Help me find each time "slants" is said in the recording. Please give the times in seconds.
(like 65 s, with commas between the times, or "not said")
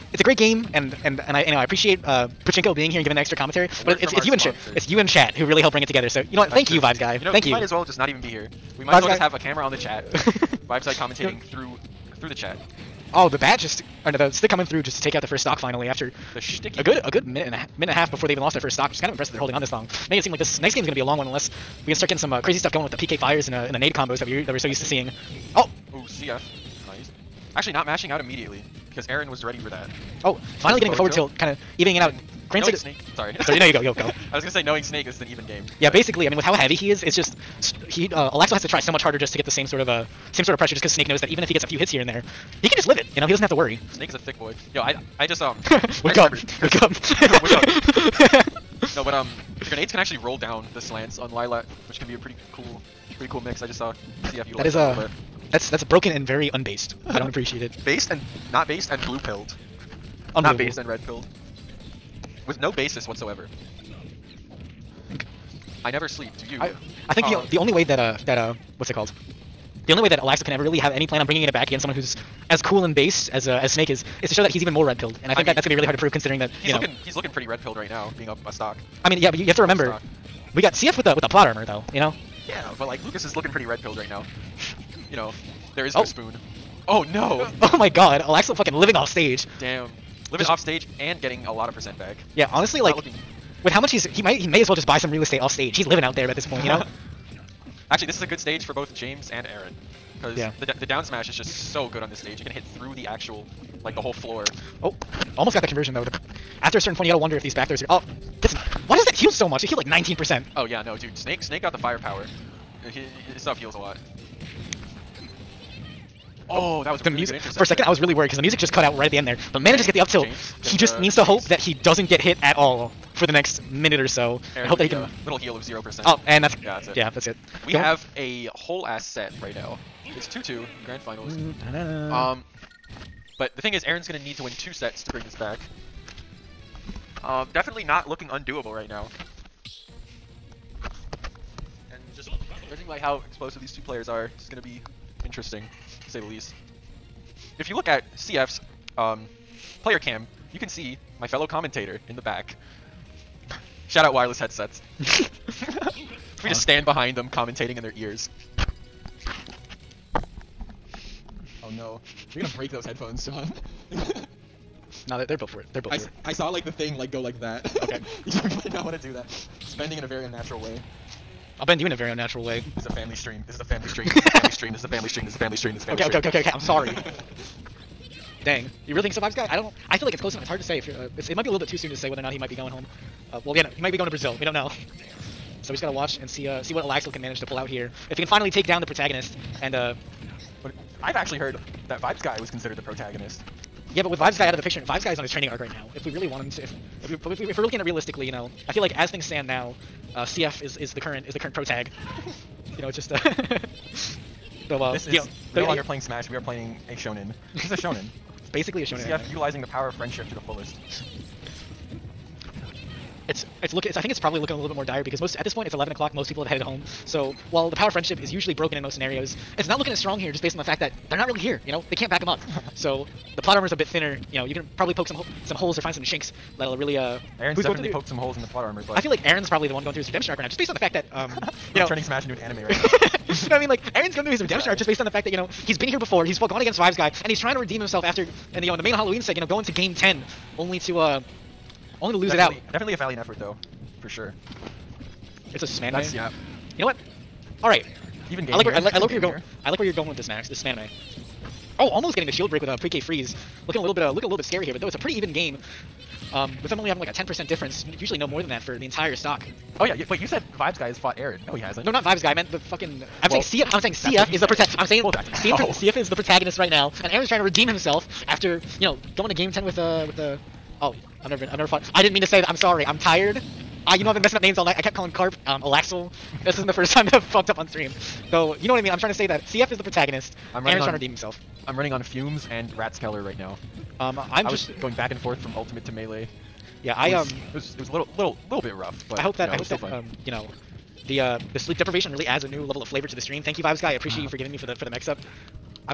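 50 s.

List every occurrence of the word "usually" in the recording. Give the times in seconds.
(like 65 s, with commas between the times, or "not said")
218 s, 257 s.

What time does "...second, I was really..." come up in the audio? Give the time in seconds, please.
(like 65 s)
117 s.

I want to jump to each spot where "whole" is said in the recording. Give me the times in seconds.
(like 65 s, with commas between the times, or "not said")
104 s, 128 s.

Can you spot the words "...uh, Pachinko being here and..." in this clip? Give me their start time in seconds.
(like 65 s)
2 s.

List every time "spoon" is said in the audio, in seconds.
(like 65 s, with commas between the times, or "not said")
86 s.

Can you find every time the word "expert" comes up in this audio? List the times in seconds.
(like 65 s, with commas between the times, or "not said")
not said.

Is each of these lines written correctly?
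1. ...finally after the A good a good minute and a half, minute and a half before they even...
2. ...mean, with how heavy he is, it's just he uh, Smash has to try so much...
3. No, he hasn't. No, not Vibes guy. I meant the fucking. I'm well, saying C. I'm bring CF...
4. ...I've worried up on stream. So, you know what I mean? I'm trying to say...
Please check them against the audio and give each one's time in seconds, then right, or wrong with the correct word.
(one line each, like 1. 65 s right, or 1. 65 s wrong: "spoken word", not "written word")
1. 15 s right
2. 36 s wrong: "Alexo", not "Smash"
3. 261 s wrong: "saying", not "bring"
4. 277 s wrong: "fucked", not "worried".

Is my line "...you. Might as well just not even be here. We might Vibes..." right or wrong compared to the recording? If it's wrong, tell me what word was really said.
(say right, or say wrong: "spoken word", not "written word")
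right.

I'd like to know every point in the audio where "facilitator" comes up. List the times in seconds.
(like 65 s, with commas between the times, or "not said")
not said.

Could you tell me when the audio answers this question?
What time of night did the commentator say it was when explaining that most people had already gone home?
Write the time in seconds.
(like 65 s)
215 s.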